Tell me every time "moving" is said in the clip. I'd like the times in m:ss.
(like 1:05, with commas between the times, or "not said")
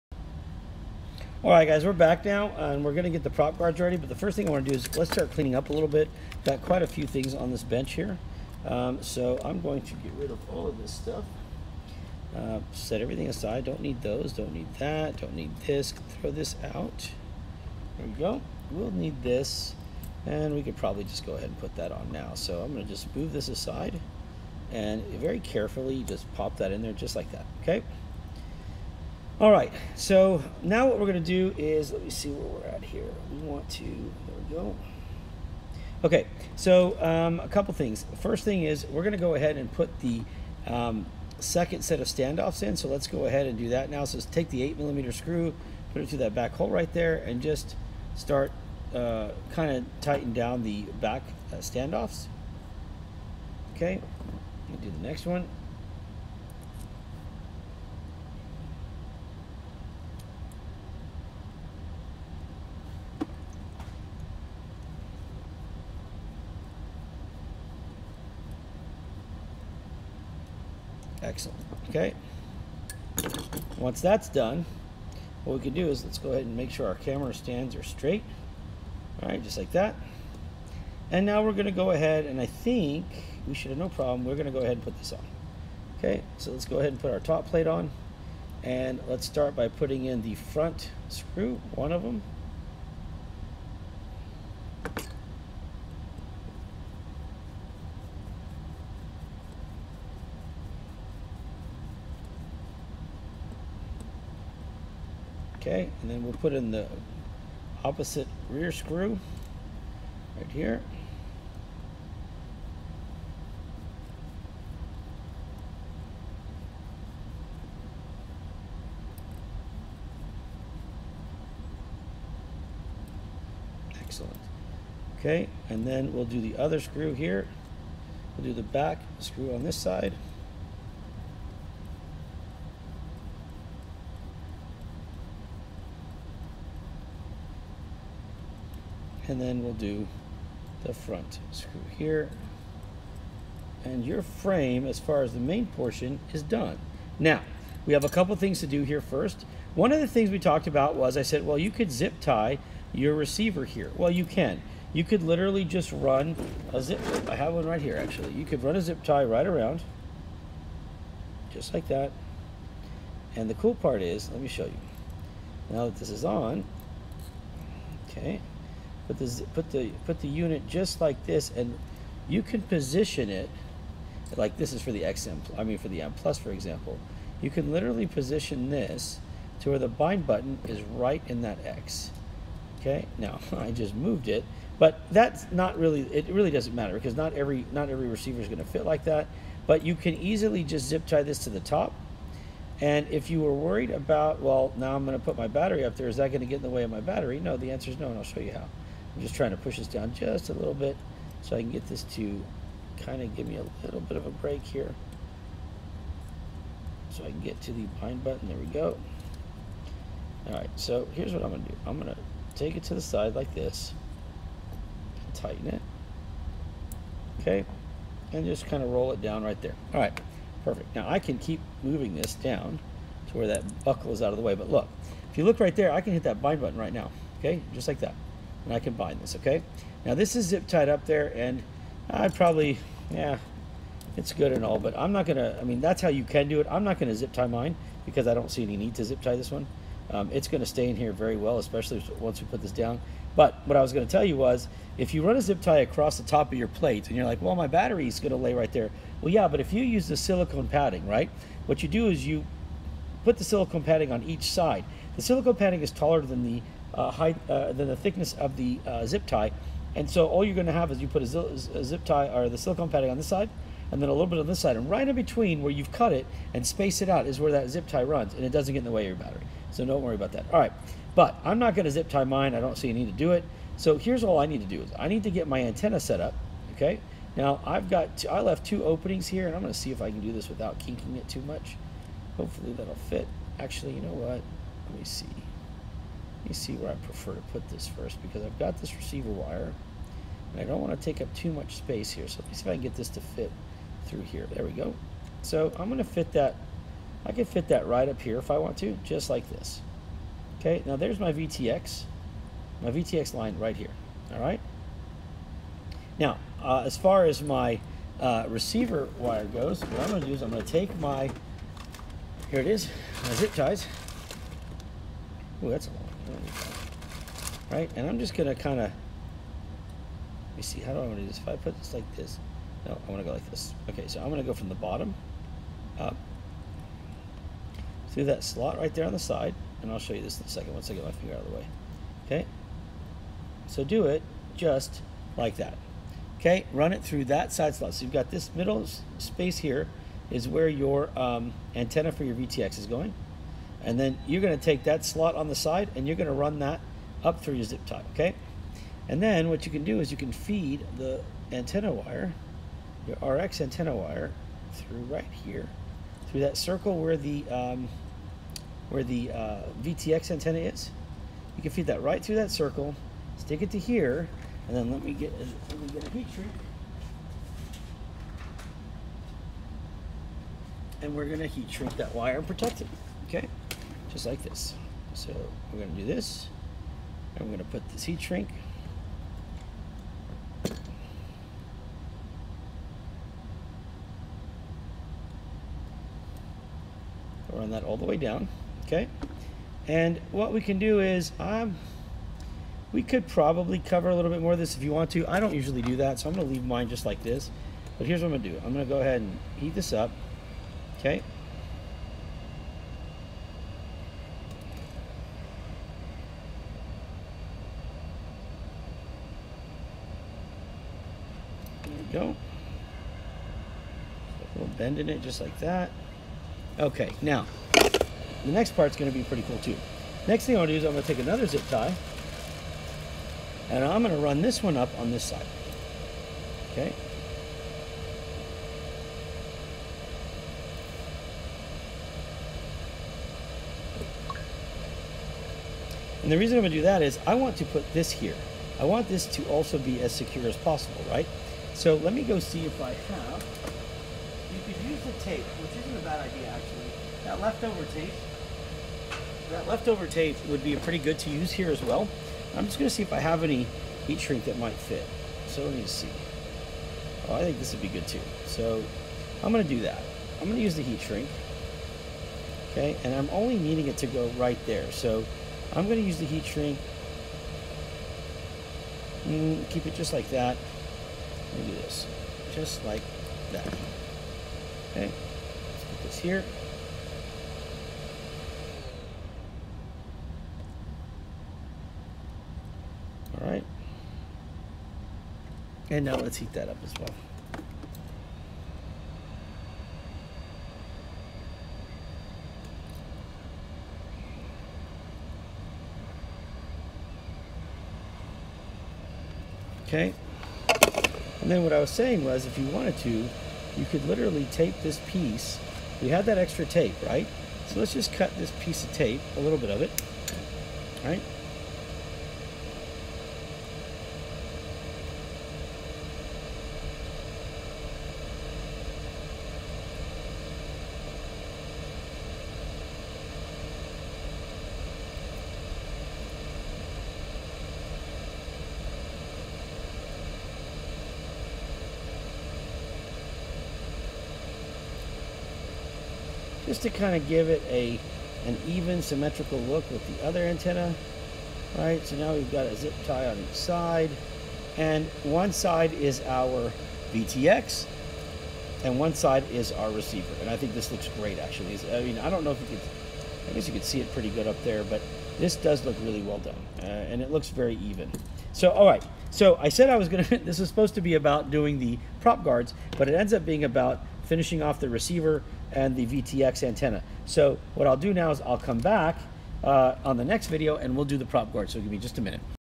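3:41.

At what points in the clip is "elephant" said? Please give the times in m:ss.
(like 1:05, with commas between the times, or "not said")
not said.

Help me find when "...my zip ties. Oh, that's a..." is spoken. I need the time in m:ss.
5:13.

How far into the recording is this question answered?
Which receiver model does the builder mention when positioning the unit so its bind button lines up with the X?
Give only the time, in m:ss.
2:56.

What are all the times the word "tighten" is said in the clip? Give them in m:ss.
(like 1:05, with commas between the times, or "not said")
0:50, 3:35.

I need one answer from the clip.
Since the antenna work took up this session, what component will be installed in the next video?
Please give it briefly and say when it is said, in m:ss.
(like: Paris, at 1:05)
prop guard, at 9:31.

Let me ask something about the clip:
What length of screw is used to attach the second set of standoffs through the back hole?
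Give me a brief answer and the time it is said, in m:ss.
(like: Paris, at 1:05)
8 millimeter, at 0:44.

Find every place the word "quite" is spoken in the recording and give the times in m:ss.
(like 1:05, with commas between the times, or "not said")
0:06.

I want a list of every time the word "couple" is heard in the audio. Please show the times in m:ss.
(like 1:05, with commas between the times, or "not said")
0:37, 2:28.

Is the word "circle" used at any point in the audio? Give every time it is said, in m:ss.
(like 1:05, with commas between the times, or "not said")
5:56, 6:02.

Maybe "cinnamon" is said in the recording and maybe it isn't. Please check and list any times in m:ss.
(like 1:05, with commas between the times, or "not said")
not said.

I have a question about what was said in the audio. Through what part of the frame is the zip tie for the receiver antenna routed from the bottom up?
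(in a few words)
side slot.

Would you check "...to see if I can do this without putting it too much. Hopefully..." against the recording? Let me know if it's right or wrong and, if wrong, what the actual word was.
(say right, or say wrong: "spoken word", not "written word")
wrong: "kinking", not "putting".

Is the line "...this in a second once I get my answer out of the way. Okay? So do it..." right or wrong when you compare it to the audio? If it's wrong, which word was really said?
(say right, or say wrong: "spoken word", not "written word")
wrong: "finger", not "answer".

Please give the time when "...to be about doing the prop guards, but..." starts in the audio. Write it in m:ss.
9:20.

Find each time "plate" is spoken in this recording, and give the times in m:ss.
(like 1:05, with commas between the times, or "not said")
1:27, 4:06.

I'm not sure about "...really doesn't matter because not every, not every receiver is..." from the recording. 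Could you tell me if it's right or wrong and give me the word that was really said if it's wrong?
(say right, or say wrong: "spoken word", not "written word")
right.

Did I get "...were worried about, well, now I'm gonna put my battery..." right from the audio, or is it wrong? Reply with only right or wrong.
right.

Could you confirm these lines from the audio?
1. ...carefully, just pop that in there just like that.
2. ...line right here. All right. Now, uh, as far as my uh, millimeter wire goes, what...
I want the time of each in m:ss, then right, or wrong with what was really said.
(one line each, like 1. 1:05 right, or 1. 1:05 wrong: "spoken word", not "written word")
1. 0:25 right
2. 5:03 wrong: "receiver", not "millimeter".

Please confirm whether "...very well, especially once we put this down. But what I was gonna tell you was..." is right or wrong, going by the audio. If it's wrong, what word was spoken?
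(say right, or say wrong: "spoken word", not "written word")
right.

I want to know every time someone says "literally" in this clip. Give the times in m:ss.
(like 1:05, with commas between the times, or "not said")
2:35, 2:57, 8:24.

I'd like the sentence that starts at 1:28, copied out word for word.
And let's start by putting in the front screw, one of them.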